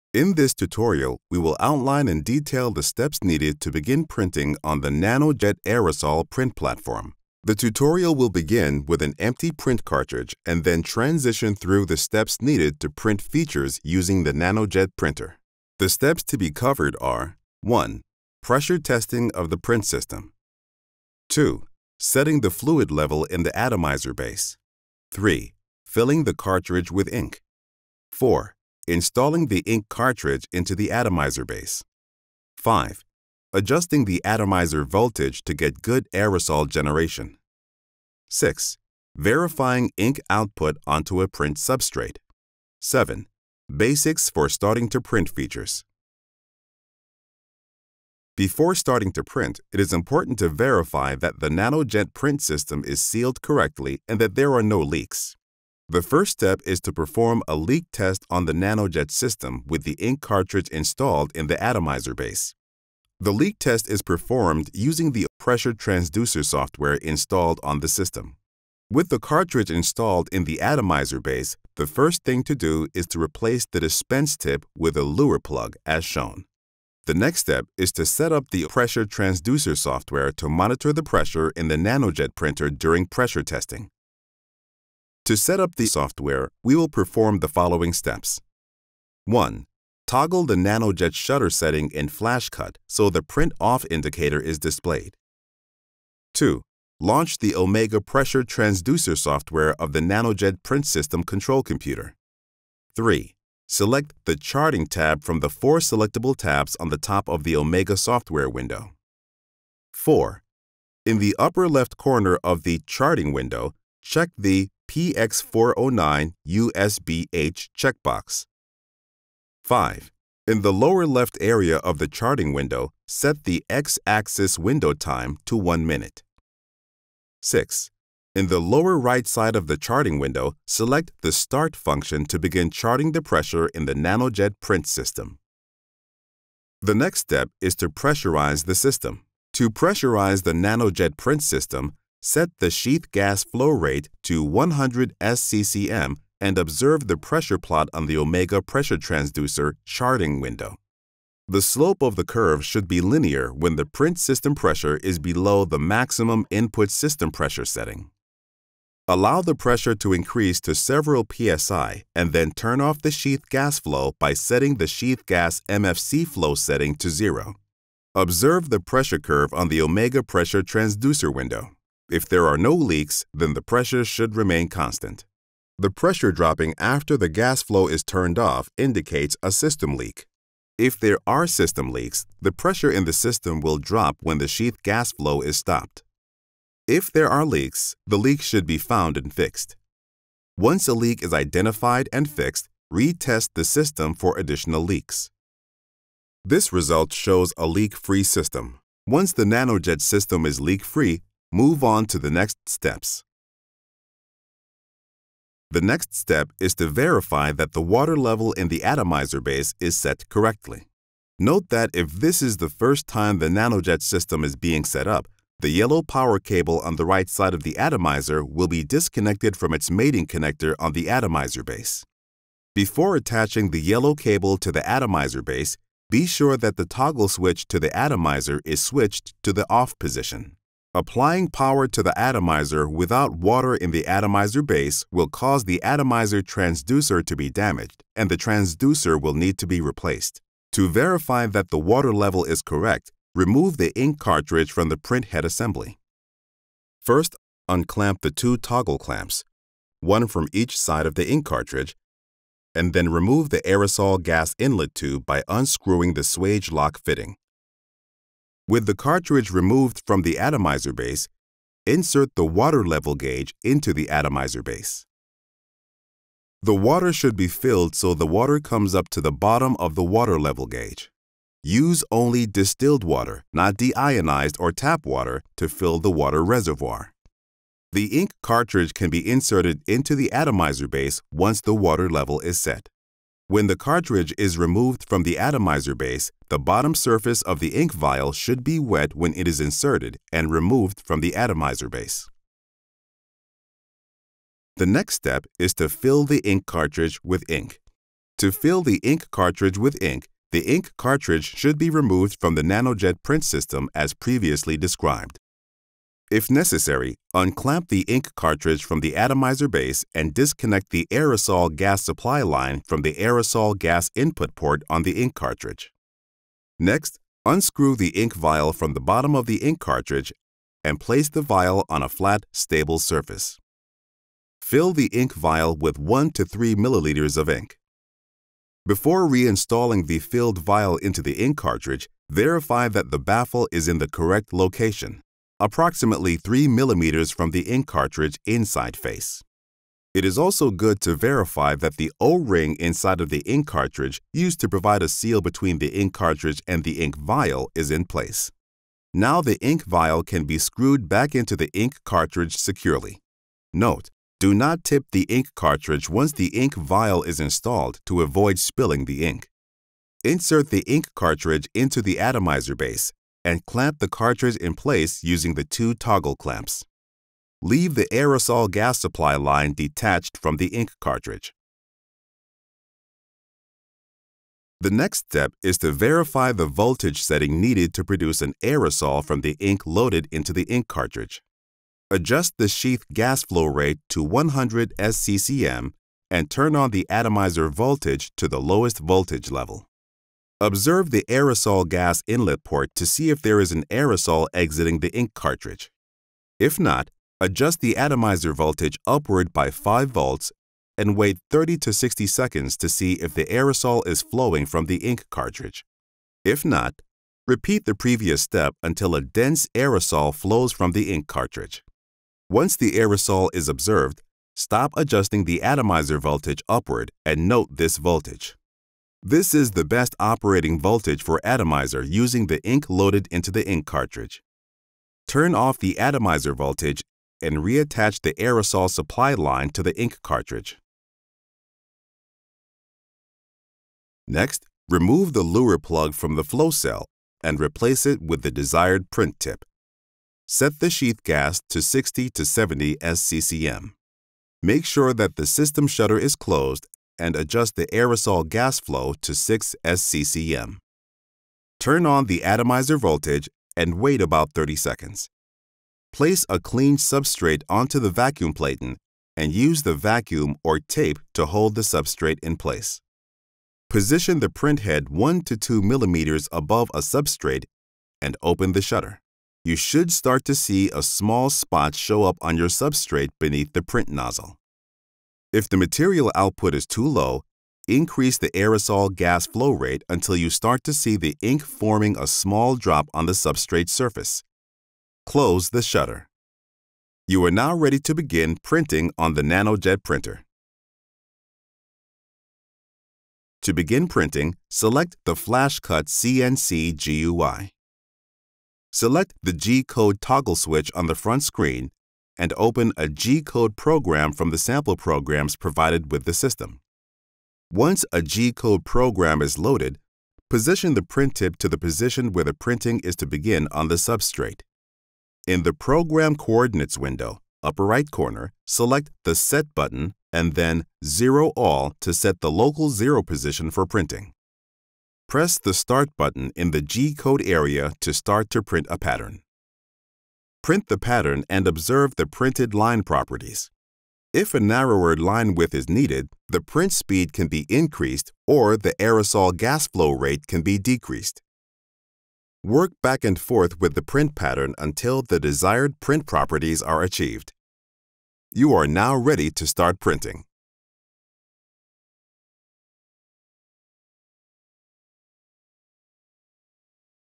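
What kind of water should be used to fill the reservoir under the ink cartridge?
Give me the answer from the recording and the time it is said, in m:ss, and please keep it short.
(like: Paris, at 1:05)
Distilled water, at 4:32.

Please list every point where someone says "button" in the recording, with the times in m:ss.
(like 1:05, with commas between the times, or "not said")
8:39, 8:46.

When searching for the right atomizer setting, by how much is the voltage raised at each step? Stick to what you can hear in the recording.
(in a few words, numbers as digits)
5 volts.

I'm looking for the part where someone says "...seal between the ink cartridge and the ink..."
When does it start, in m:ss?
5:45.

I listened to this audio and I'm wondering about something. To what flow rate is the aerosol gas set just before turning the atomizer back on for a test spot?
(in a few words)
6 SCCM.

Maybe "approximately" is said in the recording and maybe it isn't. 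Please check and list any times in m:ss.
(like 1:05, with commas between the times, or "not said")
5:35.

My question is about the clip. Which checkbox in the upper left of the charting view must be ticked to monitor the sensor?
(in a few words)
PX409 USBH.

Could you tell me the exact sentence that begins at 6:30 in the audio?
Observe the aerosol gas inlet port to see if there is an aerosol exiting the ink cartridge.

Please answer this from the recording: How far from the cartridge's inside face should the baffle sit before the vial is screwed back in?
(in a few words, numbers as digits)
3 millimeters.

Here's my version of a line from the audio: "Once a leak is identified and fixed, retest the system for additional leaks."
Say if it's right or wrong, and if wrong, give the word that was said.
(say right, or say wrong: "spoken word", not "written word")
right.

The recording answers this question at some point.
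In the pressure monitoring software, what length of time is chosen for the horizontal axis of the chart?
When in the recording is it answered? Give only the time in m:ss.
2:05.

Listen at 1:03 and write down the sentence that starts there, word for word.
The leak test is performed using the pressure transducer software installed on the system.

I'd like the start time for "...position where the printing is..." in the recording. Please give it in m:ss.
8:31.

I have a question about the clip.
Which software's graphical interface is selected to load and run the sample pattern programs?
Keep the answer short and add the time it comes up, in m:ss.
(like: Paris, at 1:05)
FlashCut CNC, at 8:15.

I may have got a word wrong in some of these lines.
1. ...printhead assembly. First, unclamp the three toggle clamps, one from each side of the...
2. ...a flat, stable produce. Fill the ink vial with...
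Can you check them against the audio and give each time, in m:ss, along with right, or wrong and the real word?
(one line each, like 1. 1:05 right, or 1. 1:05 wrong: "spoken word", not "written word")
1. 4:04 wrong: "two", not "three"
2. 5:22 wrong: "surface", not "produce".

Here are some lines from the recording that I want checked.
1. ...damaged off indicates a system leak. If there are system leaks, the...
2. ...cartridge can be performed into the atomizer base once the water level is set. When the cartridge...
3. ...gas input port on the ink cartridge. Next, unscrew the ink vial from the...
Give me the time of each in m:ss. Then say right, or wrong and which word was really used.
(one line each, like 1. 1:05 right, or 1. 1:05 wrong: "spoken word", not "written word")
1. 2:58 wrong: "turned", not "damaged"
2. 4:38 wrong: "inserted", not "performed"
3. 5:13 right.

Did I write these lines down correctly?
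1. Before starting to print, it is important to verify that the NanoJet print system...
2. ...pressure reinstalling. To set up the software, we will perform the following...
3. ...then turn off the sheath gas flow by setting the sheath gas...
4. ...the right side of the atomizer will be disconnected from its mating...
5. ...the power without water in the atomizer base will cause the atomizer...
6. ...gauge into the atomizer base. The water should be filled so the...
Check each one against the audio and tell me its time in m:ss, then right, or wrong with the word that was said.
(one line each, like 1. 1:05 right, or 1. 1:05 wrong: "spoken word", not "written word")
1. 0:48 right
2. 1:23 wrong: "testing", not "reinstalling"
3. 2:42 right
4. 3:36 right
5. 3:52 wrong: "atomizer", not "power"
6. 4:23 right.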